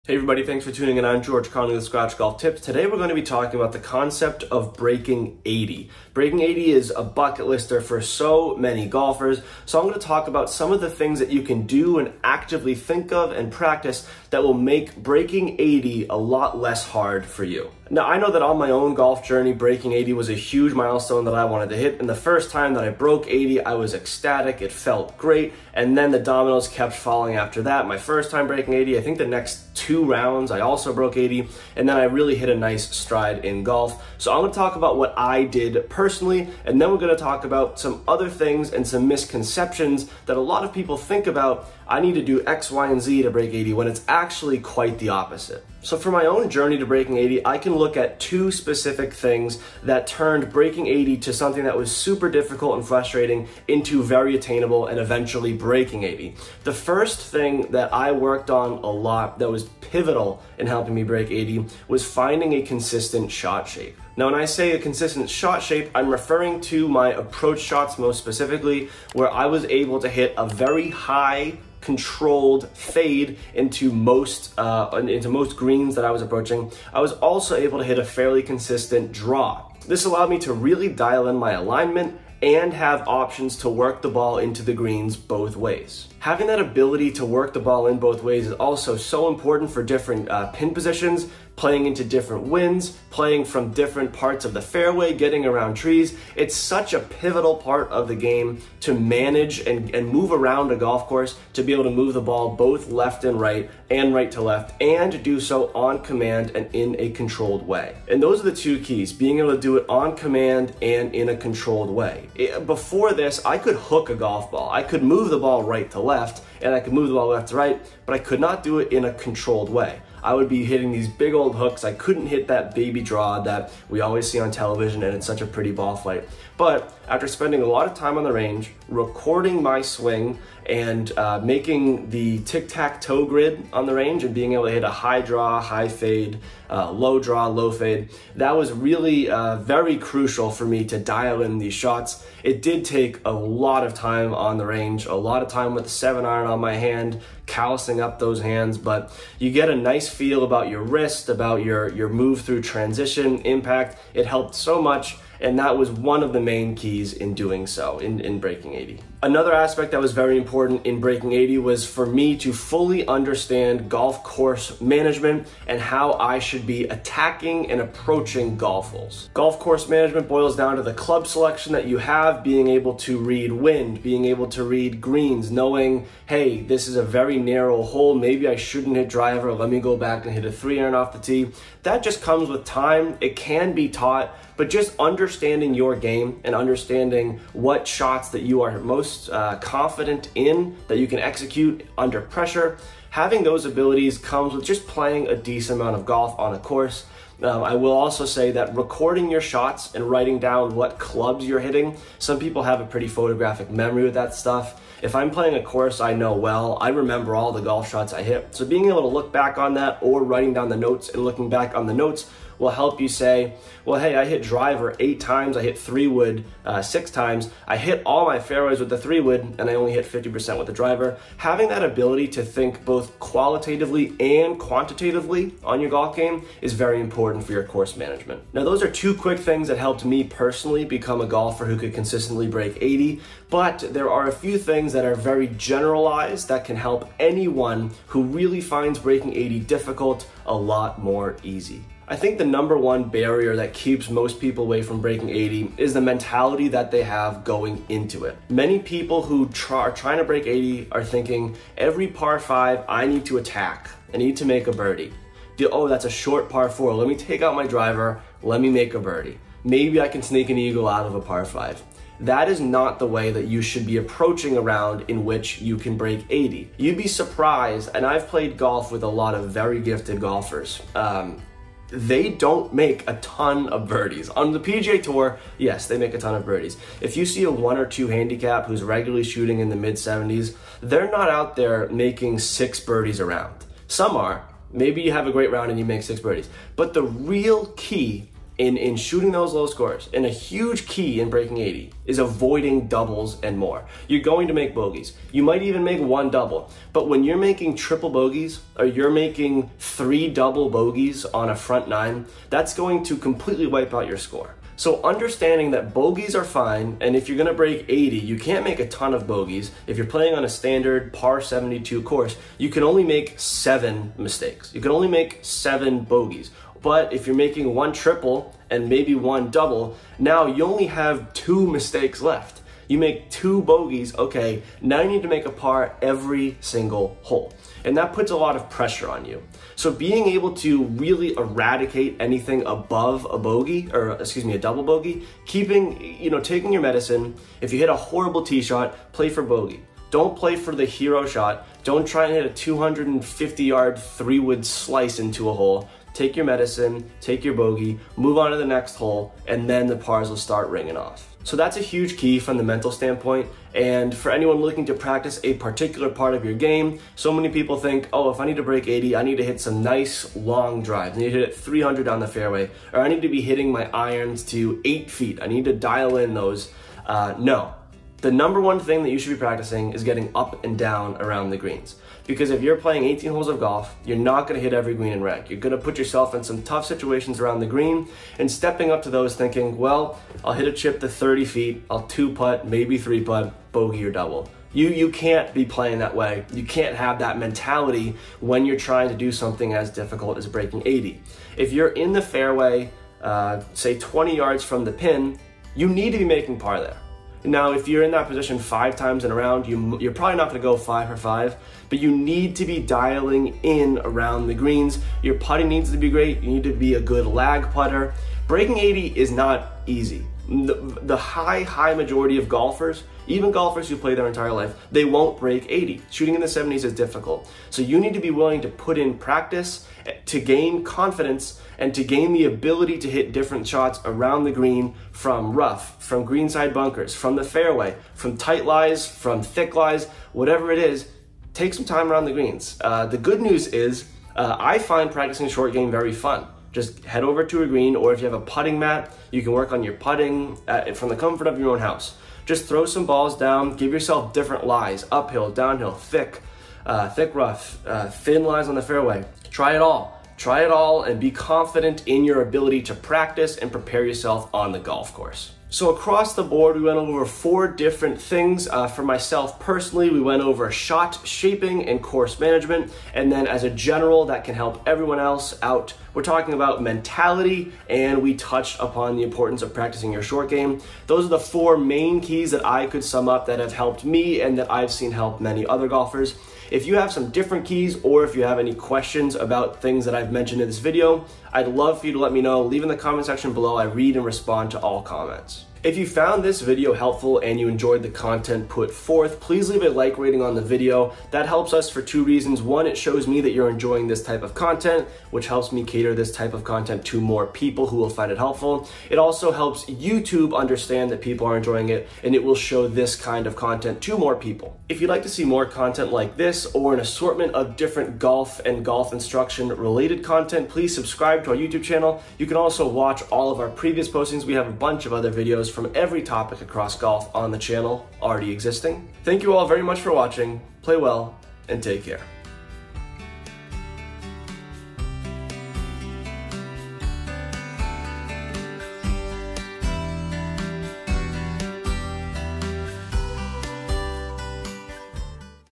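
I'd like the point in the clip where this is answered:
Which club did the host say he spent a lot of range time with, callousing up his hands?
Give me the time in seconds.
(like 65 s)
145 s.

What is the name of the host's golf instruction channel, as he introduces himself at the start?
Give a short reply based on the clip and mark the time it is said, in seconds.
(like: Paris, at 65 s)
Scratch Golf Tips, at 1 s.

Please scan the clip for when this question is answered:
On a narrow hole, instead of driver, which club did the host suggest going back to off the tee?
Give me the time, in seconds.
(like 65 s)
180 s.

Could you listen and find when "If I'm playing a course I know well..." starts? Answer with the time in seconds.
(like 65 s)
205 s.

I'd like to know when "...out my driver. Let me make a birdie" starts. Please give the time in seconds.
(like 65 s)
257 s.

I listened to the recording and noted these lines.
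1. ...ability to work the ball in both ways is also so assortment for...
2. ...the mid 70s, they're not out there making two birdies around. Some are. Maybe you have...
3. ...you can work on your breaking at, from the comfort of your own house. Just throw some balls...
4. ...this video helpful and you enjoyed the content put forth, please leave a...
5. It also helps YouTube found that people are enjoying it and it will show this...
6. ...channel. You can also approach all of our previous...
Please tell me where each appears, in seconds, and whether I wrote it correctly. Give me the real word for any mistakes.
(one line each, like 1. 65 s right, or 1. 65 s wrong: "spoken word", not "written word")
1. 86 s wrong: "important", not "assortment"
2. 279 s wrong: "six", not "two"
3. 439 s wrong: "putting", not "breaking"
4. 486 s right
5. 499 s wrong: "understand", not "found"
6. 511 s wrong: "watch", not "approach".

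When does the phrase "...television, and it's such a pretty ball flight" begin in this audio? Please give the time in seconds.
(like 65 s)
124 s.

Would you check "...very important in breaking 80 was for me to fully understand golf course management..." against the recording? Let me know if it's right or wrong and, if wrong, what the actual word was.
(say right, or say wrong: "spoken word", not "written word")
right.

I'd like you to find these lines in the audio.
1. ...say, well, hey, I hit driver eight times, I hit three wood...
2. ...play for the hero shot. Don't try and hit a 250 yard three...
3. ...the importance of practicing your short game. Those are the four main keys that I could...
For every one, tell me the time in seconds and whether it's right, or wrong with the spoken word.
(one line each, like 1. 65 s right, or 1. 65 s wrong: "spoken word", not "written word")
1. 213 s right
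2. 340 s right
3. 469 s right.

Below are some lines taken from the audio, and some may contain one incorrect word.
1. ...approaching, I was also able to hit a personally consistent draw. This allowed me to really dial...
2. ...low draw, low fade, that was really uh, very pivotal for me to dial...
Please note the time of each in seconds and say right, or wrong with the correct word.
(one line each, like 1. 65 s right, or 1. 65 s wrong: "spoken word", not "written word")
1. 76 s wrong: "fairly", not "personally"
2. 136 s wrong: "crucial", not "pivotal".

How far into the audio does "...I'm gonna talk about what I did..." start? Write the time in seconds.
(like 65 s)
34 s.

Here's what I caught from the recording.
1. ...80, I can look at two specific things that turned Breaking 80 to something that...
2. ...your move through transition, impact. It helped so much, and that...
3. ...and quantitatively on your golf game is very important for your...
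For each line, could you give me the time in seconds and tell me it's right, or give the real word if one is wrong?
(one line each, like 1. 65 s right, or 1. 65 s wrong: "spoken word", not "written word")
1. 47 s right
2. 151 s right
3. 224 s right.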